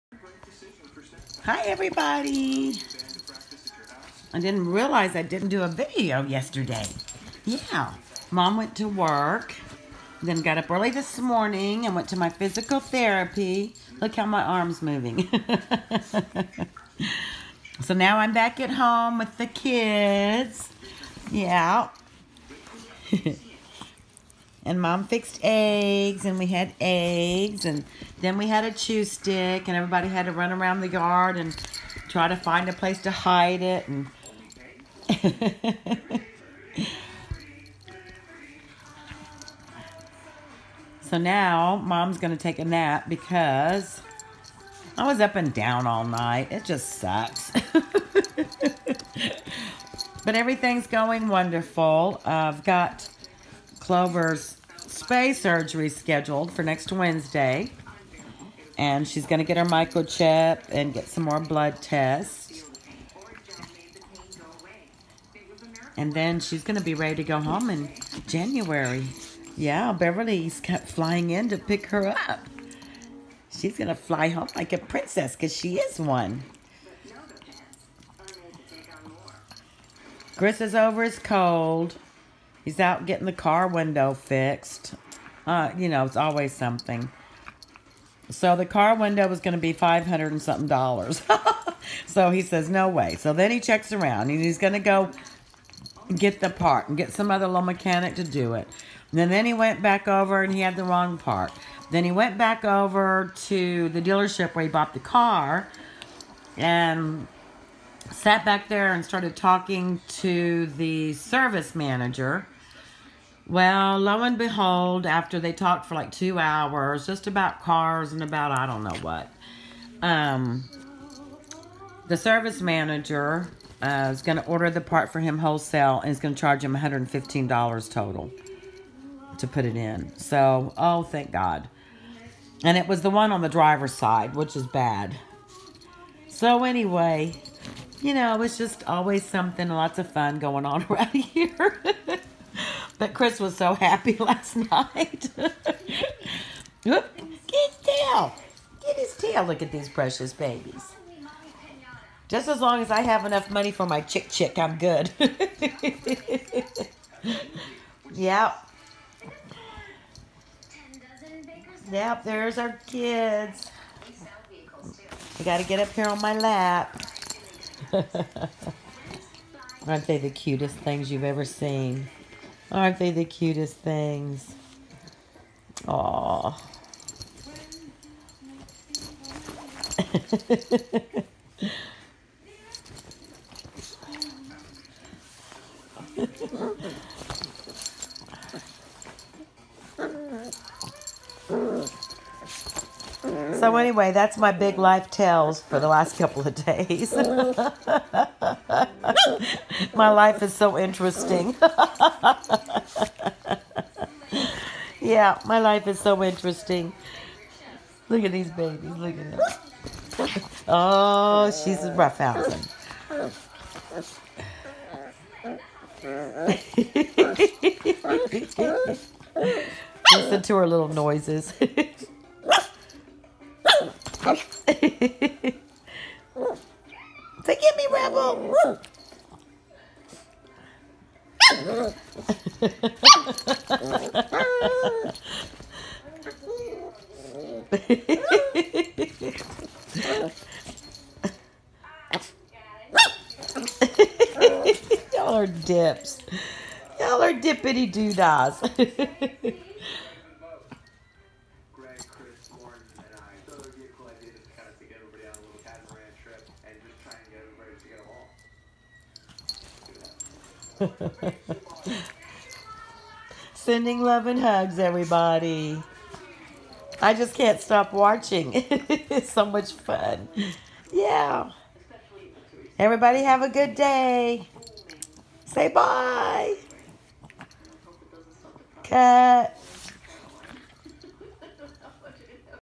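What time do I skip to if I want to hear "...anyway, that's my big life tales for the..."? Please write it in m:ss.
3:13.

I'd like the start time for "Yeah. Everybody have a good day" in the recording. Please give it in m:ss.
4:30.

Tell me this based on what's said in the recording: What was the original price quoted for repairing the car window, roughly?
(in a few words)
500 and something dollars.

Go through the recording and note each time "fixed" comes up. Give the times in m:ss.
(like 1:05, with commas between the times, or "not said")
0:25, 1:24.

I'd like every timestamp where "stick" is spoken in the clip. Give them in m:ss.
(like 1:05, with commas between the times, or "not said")
0:29.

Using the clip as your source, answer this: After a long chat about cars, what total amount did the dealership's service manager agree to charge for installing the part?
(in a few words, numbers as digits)
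$115.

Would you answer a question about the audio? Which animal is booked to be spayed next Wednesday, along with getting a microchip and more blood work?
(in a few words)
Clover.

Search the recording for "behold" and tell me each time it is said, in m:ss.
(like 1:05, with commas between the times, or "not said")
1:54.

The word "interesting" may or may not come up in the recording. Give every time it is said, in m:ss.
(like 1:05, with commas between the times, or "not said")
3:20, 3:26.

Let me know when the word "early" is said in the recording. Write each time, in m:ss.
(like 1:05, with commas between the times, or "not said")
0:10.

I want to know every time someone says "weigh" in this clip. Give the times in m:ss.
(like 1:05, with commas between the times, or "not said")
not said.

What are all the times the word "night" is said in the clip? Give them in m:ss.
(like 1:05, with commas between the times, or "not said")
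0:46, 2:24.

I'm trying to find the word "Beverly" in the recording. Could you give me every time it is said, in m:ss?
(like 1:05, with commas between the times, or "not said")
1:09.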